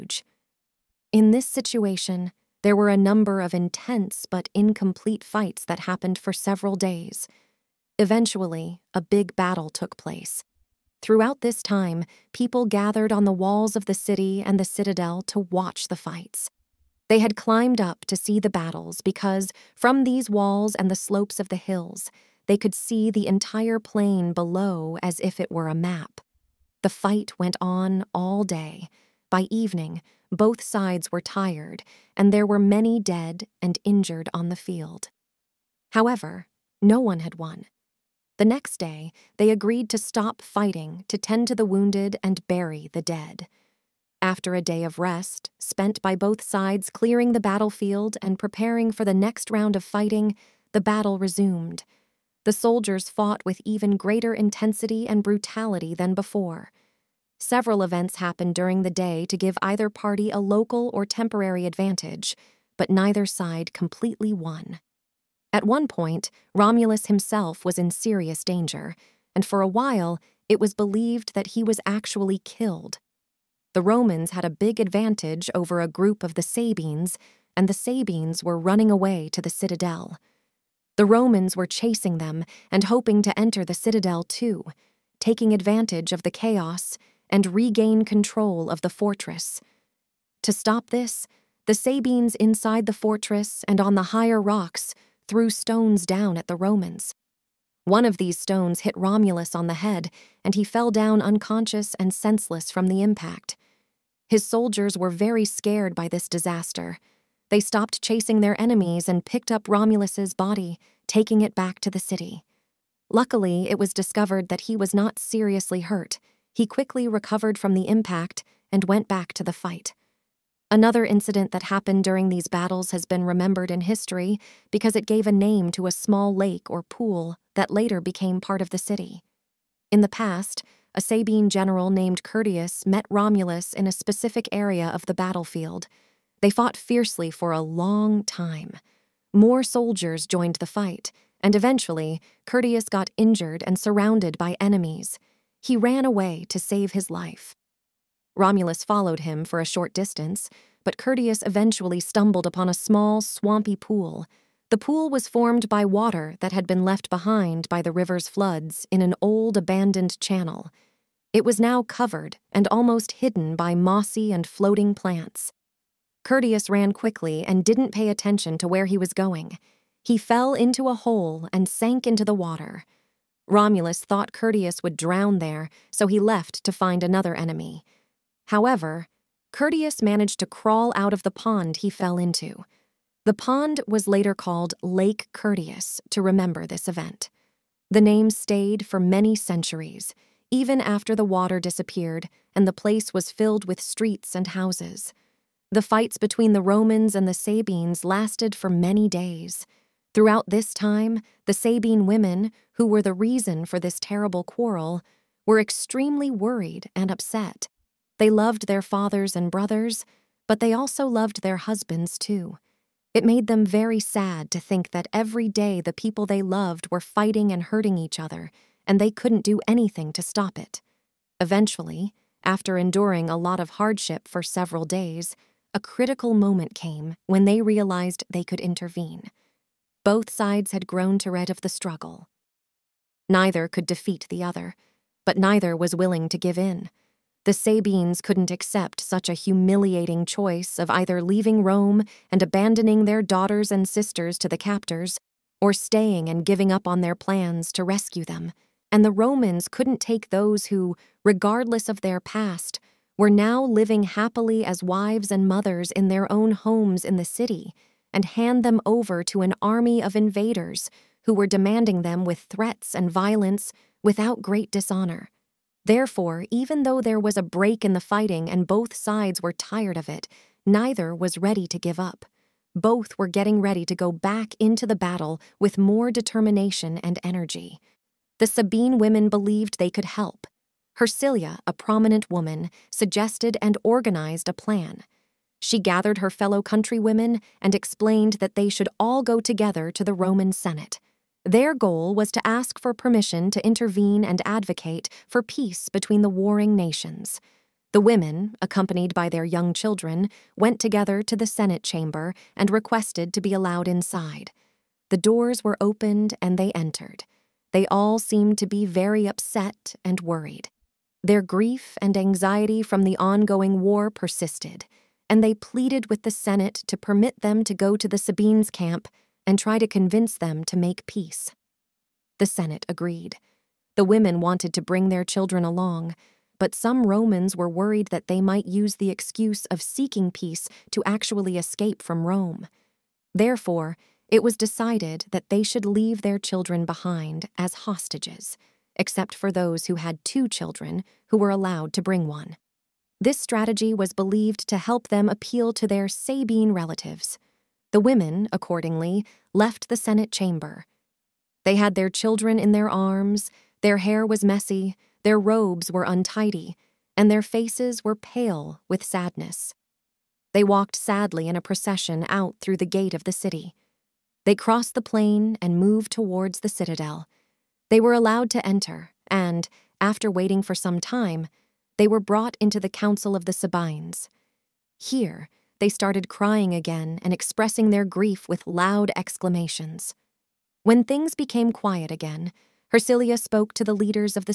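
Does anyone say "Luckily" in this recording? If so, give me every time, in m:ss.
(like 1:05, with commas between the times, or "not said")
1:53.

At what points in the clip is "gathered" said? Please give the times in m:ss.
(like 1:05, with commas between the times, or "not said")
0:12, 4:45.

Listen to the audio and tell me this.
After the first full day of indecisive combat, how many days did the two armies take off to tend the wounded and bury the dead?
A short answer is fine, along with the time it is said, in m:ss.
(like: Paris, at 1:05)
1, at 0:38.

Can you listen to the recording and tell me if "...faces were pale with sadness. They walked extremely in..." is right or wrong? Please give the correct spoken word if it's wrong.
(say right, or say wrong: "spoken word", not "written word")
wrong: "sadly", not "extremely".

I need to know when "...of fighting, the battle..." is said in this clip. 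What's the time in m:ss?
0:49.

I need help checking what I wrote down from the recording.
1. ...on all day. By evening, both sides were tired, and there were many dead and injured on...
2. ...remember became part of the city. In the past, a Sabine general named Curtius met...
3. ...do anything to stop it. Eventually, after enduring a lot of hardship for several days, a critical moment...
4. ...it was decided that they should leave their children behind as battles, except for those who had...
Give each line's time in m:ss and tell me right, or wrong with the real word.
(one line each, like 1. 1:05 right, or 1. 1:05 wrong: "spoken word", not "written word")
1. 0:27 right
2. 2:07 wrong: "later", not "remember"
3. 3:39 right
4. 5:34 wrong: "hostages", not "battles".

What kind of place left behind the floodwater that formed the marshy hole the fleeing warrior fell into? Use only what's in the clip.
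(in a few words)
An old abandoned channel.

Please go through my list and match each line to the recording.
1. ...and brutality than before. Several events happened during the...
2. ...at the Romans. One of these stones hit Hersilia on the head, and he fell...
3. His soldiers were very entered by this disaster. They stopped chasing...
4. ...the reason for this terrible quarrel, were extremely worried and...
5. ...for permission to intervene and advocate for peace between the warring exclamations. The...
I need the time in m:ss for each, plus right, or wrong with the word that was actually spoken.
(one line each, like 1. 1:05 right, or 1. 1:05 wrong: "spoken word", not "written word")
1. 0:55 right
2. 1:36 wrong: "Romulus", not "Hersilia"
3. 1:44 wrong: "scared", not "entered"
4. 3:23 right
5. 4:52 wrong: "nations", not "exclamations".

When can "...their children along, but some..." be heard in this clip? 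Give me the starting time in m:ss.
5:25.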